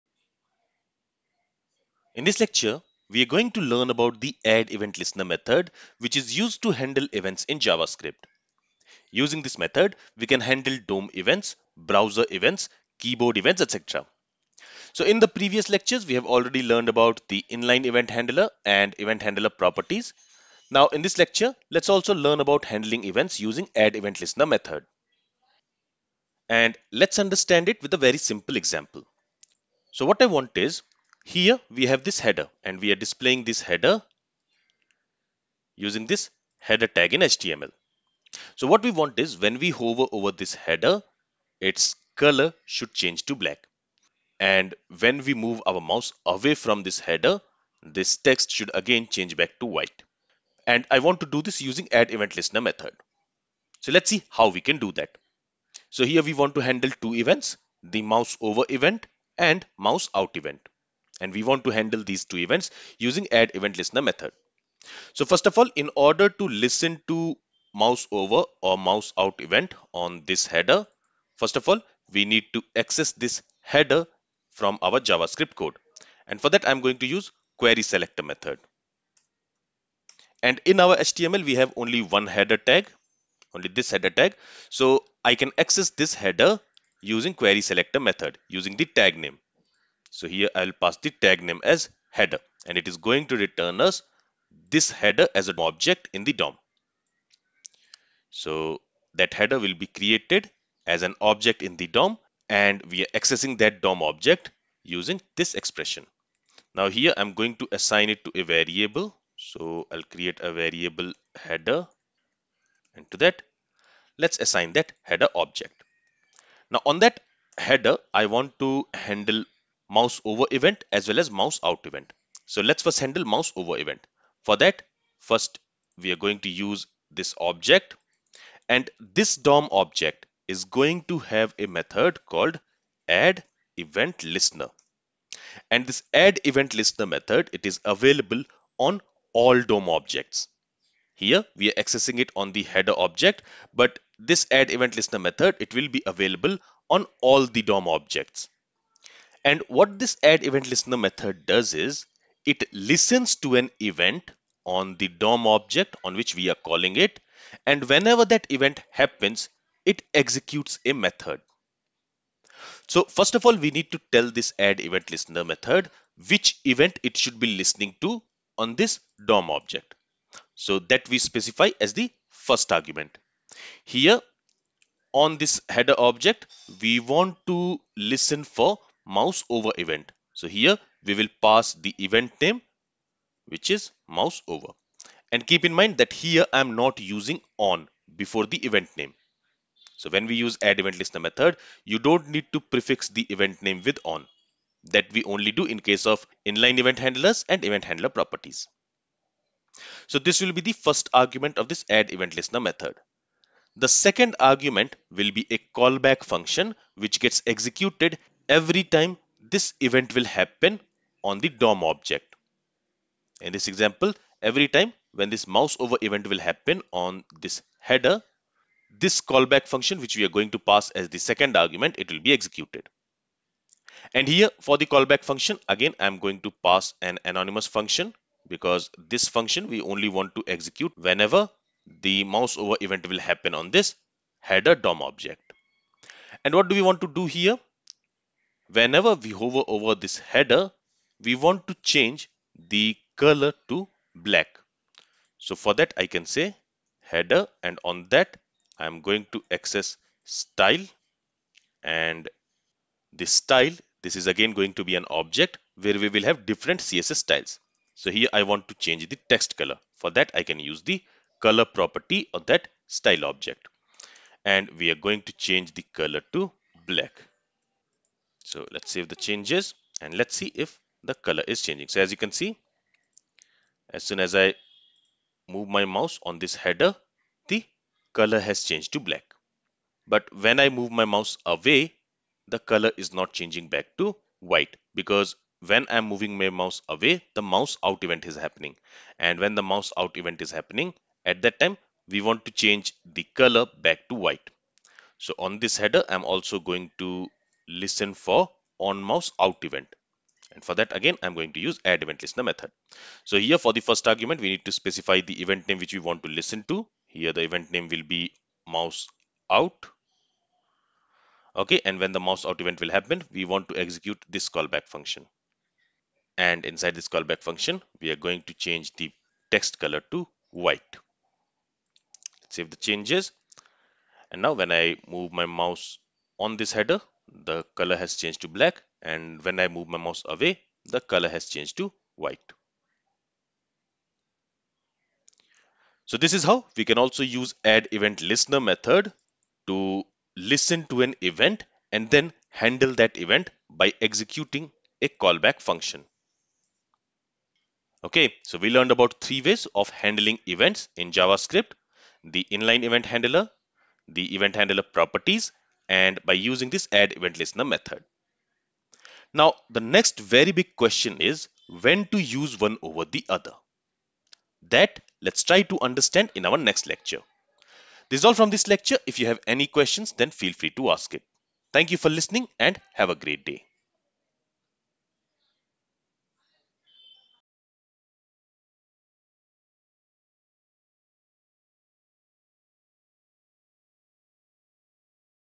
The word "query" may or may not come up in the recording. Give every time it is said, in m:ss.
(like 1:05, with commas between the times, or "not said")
1:17, 1:27.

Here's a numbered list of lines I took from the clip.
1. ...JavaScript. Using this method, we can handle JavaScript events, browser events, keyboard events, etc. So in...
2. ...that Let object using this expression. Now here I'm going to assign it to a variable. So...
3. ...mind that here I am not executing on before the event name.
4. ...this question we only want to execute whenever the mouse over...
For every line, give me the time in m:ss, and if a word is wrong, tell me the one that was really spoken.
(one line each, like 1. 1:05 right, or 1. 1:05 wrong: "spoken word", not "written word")
1. 0:07 wrong: "DOM", not "JavaScript"
2. 1:43 wrong: "DOM", not "Let"
3. 3:05 wrong: "using", not "executing"
4. 3:48 wrong: "function", not "question".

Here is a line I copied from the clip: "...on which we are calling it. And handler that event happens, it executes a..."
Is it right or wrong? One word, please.
wrong.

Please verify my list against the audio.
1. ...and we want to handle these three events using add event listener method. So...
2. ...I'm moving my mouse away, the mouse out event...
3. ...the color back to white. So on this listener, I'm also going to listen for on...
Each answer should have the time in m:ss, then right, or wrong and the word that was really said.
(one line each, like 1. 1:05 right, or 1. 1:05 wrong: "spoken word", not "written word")
1. 1:01 wrong: "two", not "three"
2. 4:45 right
3. 4:53 wrong: "header", not "listener".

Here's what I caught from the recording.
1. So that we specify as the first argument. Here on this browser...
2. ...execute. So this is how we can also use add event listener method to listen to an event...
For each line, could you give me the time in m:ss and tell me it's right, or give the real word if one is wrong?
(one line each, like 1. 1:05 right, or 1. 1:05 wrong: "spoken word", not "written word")
1. 2:50 wrong: "header", not "browser"
2. 5:32 wrong: "white", not "execute".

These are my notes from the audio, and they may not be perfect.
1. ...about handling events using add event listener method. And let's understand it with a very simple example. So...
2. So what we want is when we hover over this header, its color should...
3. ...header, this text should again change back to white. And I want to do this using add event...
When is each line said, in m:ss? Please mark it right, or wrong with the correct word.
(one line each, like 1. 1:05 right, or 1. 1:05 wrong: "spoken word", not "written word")
1. 0:22 right
2. 0:38 right
3. 0:46 right.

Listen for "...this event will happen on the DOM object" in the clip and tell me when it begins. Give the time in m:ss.
3:29.